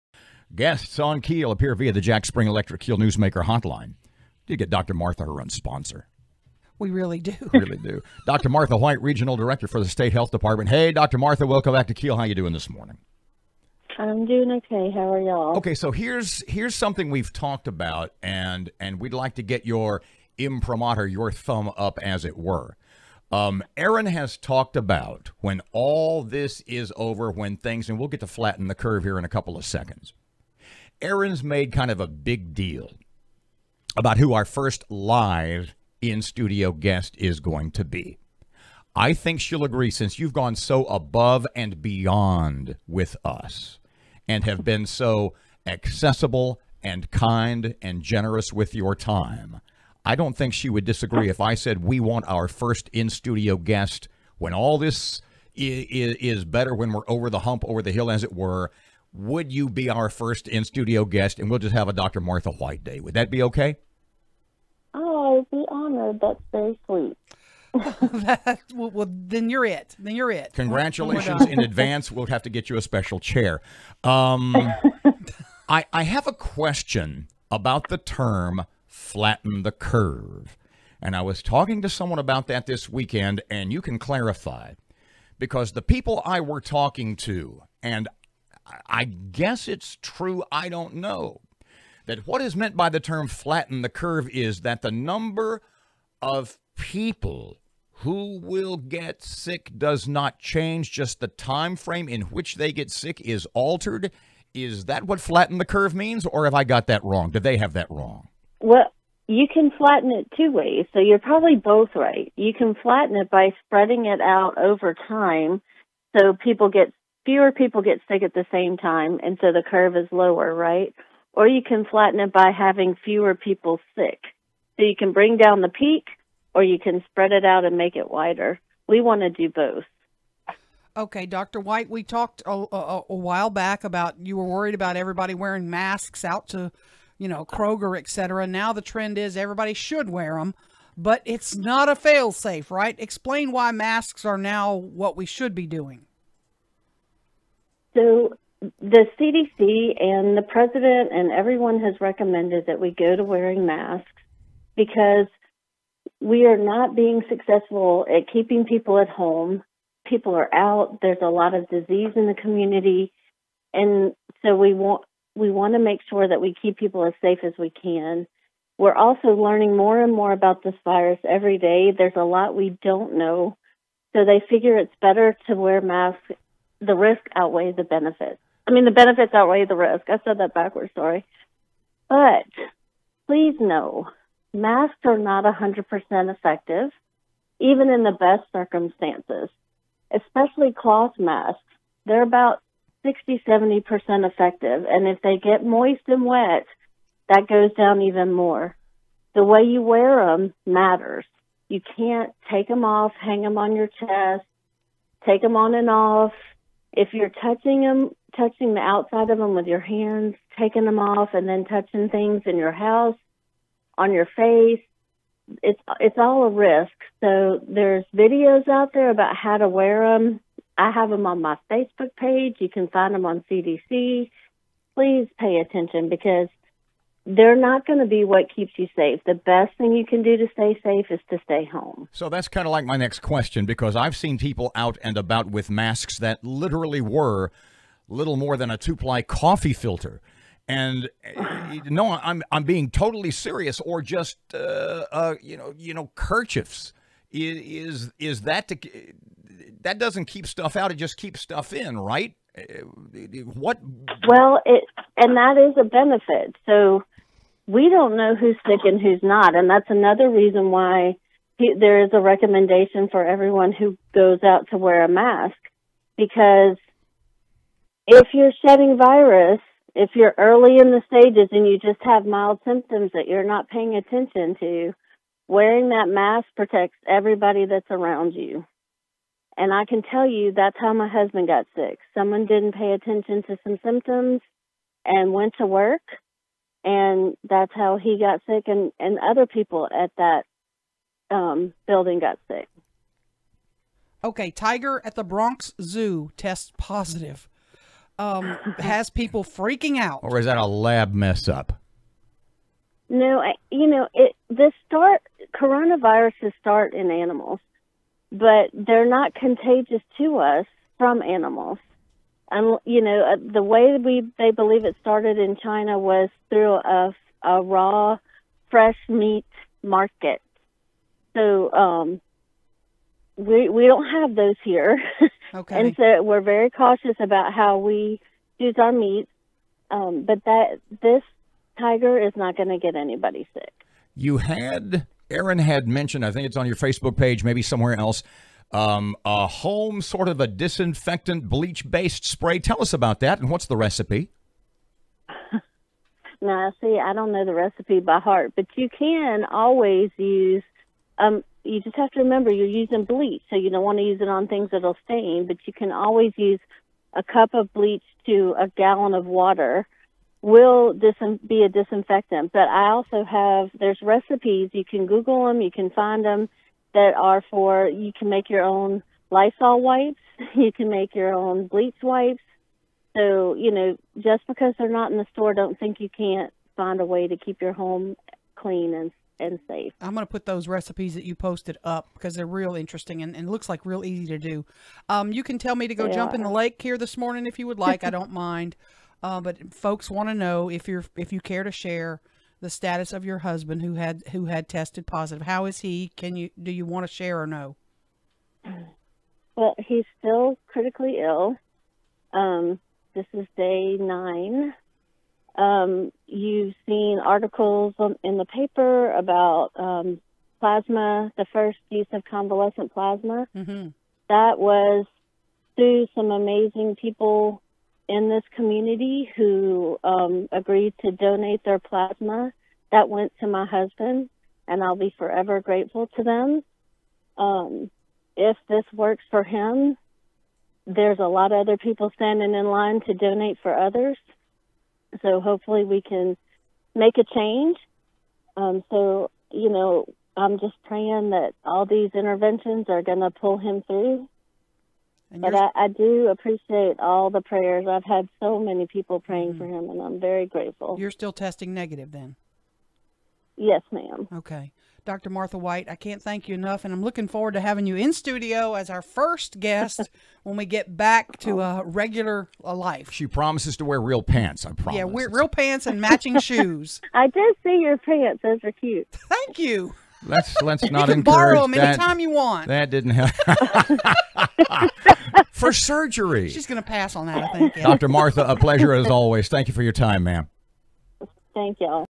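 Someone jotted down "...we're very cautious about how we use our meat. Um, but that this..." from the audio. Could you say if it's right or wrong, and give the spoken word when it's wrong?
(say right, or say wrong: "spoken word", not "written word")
right.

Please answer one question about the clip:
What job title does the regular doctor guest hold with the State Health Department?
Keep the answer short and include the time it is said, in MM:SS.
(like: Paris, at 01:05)
Regional Director, at 00:09.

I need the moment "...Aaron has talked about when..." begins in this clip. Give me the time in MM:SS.
00:23.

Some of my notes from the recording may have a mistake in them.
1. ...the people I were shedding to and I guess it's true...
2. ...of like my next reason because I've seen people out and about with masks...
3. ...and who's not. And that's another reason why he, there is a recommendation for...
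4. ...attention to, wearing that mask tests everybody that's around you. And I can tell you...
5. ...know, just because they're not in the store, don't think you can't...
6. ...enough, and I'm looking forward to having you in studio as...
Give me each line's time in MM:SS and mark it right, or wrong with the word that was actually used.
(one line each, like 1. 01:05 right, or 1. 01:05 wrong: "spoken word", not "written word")
1. 01:25 wrong: "talking", not "shedding"
2. 03:52 wrong: "question", not "reason"
3. 04:18 right
4. 04:33 wrong: "protects", not "tests"
5. 06:13 right
6. 07:36 right.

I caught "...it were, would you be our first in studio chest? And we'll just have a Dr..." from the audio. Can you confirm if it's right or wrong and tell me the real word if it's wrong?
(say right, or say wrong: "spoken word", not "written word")
wrong: "guest", not "chest".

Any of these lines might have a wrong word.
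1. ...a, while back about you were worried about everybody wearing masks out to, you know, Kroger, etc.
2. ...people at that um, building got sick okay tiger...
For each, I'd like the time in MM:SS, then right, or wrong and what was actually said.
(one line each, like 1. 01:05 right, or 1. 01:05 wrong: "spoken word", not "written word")
1. 02:13 right
2. 04:49 right.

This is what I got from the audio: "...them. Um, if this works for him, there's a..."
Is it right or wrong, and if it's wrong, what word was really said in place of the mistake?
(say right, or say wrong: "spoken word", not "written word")
right.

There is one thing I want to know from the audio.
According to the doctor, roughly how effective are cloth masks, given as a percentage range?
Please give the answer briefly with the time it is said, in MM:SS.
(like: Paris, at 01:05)
60-70%, at 03:13.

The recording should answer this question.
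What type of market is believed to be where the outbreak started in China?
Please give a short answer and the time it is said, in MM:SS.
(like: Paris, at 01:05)
Raw fresh meat market, at 05:17.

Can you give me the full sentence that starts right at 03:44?
Please pay attention because they're not going to be what keeps you safe.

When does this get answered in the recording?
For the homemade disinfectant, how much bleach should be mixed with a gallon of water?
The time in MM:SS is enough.
05:57.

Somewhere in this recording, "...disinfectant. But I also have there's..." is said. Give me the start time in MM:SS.
06:01.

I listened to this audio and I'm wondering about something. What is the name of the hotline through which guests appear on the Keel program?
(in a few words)
Jack Spring Electric Keel Newsmaker hotline.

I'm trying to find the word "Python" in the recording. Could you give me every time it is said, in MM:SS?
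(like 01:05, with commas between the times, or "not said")
not said.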